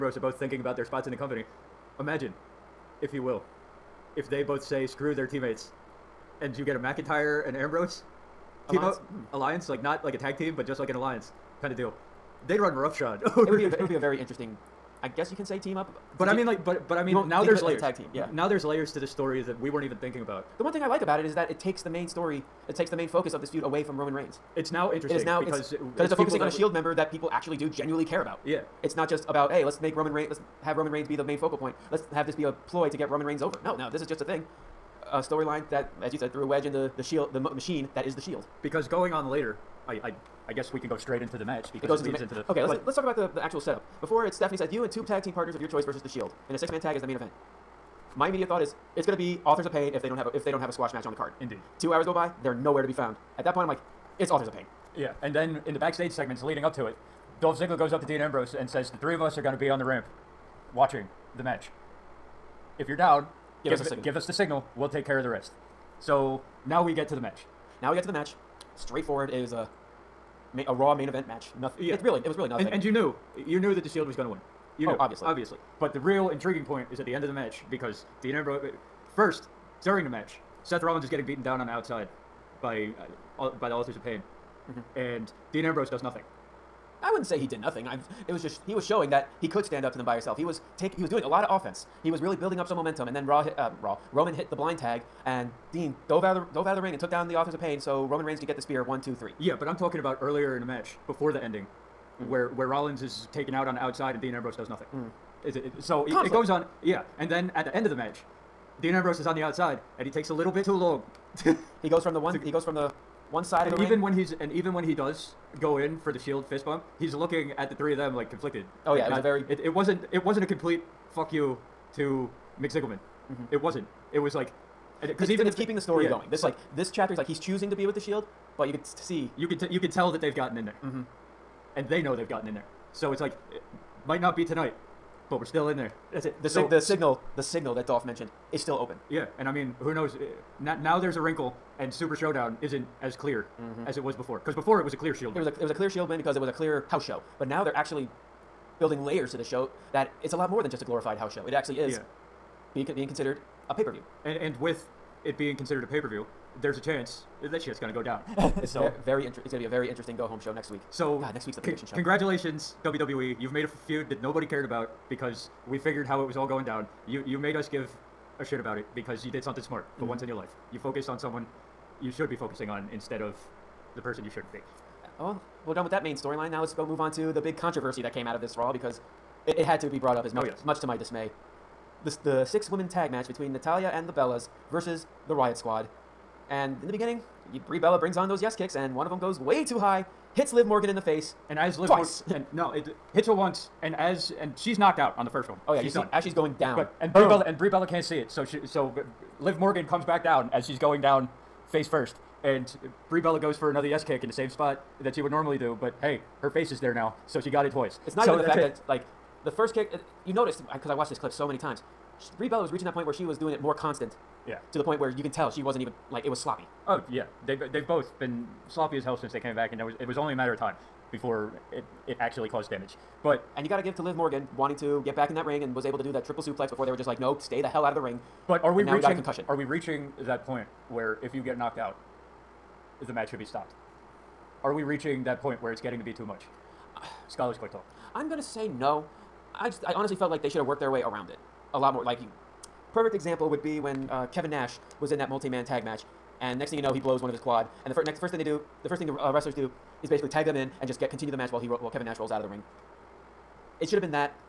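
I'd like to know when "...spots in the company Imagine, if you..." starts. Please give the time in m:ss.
0:00.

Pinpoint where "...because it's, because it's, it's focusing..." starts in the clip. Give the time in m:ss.
0:25.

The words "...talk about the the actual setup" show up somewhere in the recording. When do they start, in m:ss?
0:42.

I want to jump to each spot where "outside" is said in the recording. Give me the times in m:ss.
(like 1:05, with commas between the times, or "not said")
1:21, 1:43, 1:49.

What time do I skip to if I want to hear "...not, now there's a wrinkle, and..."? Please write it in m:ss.
2:20.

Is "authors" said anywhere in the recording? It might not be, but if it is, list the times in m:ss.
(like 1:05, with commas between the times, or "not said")
0:49, 0:54, 1:23, 1:37.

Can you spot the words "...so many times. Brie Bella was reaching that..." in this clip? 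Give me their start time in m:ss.
3:31.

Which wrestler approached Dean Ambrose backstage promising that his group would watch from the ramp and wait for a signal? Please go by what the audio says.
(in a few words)
Dolph Ziggler.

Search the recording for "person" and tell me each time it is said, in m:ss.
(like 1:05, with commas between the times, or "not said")
2:54.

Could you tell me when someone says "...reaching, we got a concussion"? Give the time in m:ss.
3:48.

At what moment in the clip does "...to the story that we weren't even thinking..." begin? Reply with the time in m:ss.
0:18.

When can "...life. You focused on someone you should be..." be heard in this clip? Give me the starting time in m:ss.
2:50.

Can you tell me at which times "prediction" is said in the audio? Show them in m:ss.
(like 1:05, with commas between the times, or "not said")
2:41.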